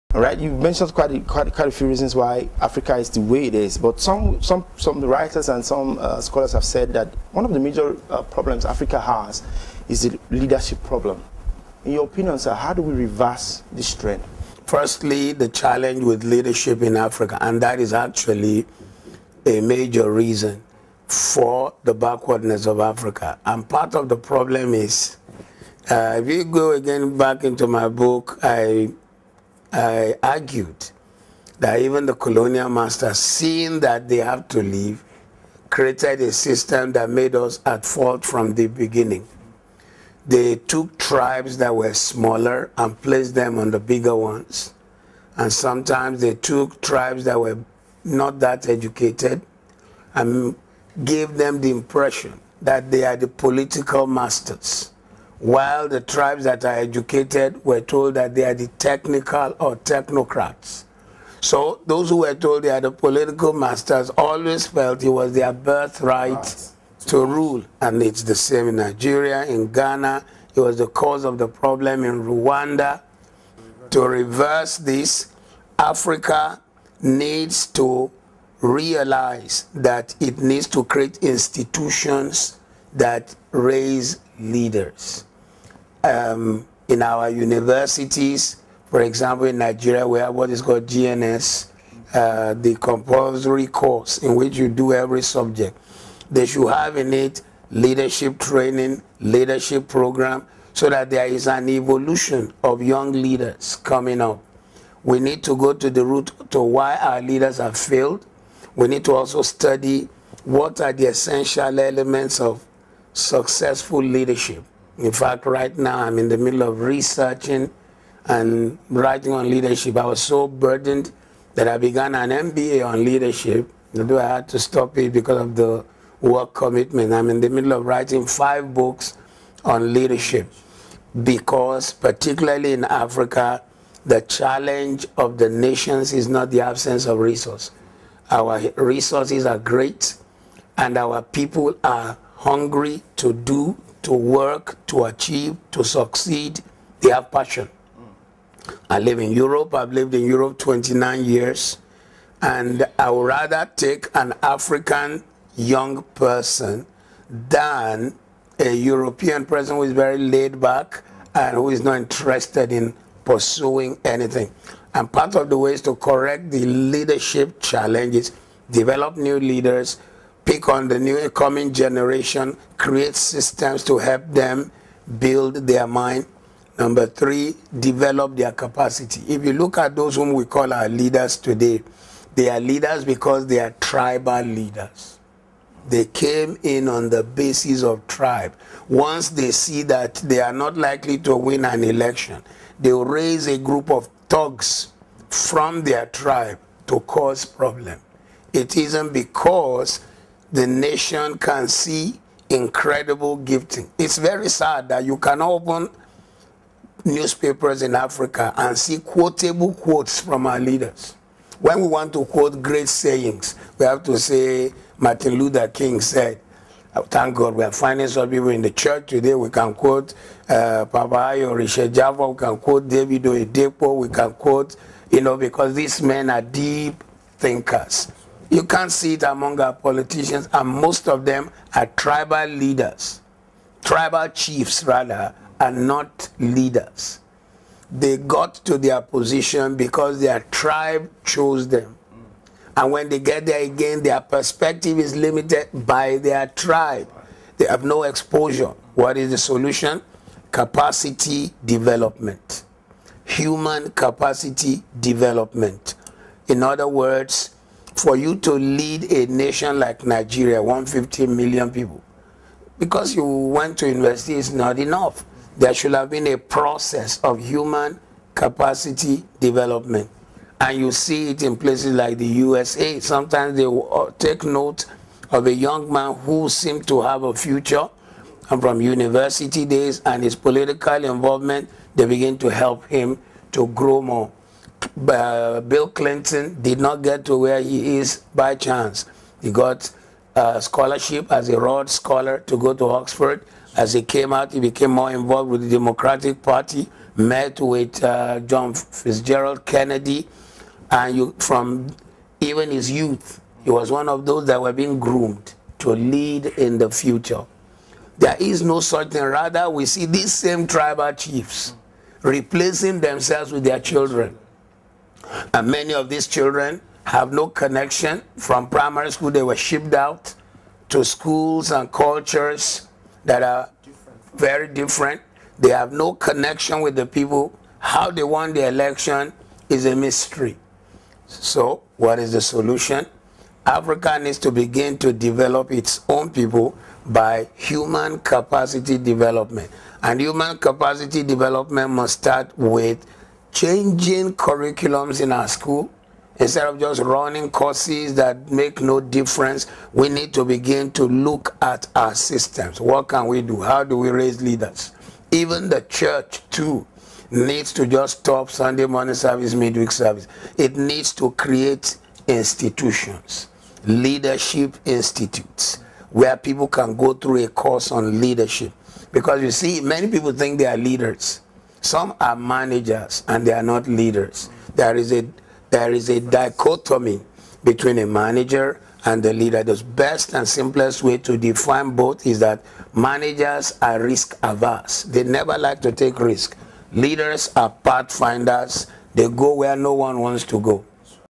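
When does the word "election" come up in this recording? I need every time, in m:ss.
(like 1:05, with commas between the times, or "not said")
3:11, 5:28.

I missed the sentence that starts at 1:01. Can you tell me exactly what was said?
So those who were told they are the political masters always felt it was their birthright right.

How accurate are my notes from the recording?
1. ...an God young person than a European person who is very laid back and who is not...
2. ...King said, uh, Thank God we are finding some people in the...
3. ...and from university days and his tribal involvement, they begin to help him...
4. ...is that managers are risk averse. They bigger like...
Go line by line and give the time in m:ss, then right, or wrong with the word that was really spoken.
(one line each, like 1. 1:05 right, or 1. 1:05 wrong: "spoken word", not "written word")
1. 2:34 wrong: "African", not "God"
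2. 3:35 right
3. 4:38 wrong: "political", not "tribal"
4. 6:22 wrong: "never", not "bigger".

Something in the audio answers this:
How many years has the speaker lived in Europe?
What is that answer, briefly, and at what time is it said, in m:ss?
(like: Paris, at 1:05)
29, at 2:30.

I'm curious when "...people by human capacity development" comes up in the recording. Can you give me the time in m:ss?
5:36.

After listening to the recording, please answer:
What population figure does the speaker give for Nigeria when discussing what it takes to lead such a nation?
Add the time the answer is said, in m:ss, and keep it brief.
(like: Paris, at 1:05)
150 million, at 4:20.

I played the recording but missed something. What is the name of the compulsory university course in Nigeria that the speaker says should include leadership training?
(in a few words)
GNS.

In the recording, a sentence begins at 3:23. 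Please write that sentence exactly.
It's very sad that you can open newspapers in Africa and see quotable quotes from our leaders.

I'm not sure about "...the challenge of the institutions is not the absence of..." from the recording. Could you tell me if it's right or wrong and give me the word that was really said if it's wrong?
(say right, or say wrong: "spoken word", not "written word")
wrong: "nations", not "institutions".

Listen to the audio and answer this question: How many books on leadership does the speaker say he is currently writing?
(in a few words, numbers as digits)
5.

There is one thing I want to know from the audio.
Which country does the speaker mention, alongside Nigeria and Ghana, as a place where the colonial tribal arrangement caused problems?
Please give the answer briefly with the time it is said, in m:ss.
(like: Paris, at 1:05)
Rwanda, at 1:12.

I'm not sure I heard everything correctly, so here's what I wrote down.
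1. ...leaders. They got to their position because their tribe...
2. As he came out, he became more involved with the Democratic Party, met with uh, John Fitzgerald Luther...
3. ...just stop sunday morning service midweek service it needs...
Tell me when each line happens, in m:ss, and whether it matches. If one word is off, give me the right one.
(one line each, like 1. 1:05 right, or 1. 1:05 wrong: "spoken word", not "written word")
1. 3:56 right
2. 4:53 wrong: "Kennedy", not "Luther"
3. 5:57 right.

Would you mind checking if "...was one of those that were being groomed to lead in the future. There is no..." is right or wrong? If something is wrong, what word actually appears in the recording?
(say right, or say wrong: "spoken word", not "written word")
right.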